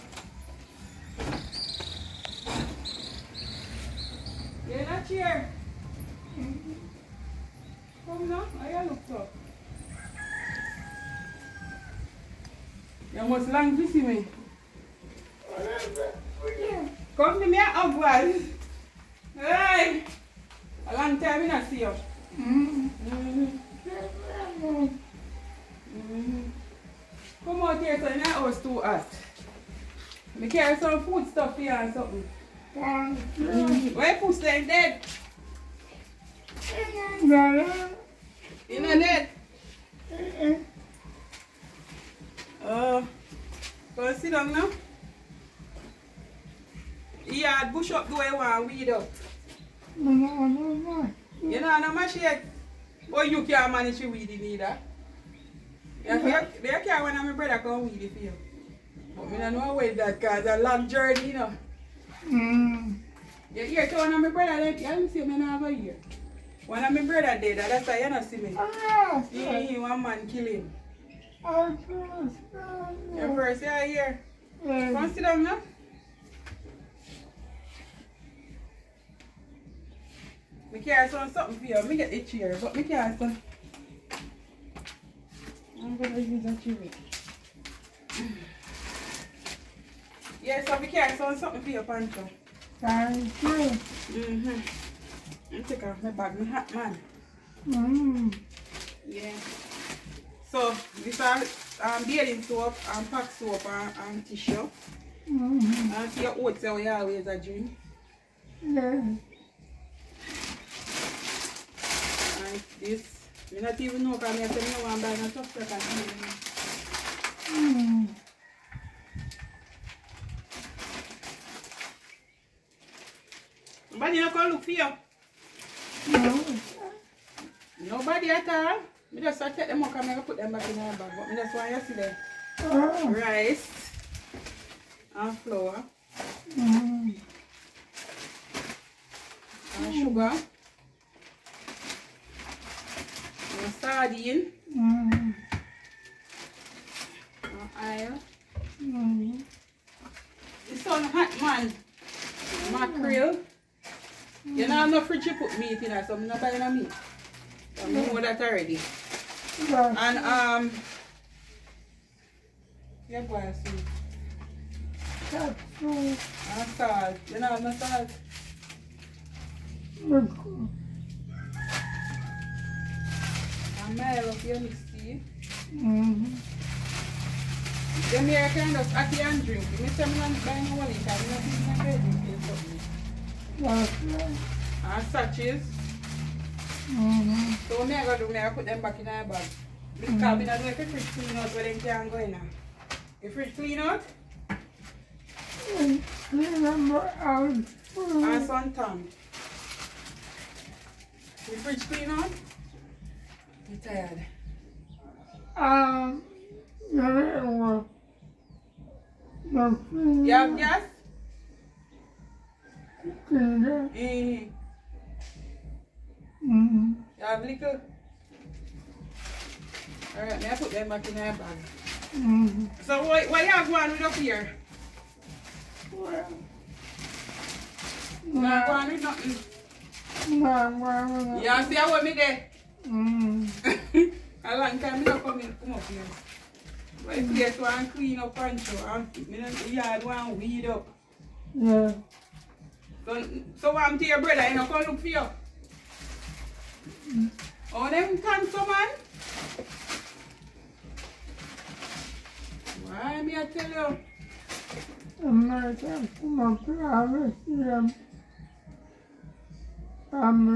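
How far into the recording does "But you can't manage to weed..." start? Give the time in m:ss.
0:53.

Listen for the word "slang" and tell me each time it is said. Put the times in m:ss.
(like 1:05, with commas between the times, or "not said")
0:13.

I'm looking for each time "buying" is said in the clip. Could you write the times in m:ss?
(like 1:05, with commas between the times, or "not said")
2:36, 3:00.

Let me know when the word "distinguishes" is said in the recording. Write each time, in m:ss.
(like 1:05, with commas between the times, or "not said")
not said.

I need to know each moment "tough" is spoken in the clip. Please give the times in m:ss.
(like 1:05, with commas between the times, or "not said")
1:55.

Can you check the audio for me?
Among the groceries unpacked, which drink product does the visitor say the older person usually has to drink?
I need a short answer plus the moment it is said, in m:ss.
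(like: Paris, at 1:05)
oats, at 1:46.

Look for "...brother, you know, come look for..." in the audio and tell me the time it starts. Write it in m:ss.
4:04.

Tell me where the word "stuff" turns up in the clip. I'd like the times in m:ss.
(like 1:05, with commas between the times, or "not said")
0:31, 1:55.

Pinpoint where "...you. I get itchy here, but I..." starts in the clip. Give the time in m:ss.
1:21.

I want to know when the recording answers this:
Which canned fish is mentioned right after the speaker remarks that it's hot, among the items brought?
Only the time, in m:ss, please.
2:32.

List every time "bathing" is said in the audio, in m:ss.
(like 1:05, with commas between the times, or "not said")
1:42.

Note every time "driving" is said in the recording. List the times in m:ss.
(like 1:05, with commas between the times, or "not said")
not said.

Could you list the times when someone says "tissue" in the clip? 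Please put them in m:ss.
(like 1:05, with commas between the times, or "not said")
1:44.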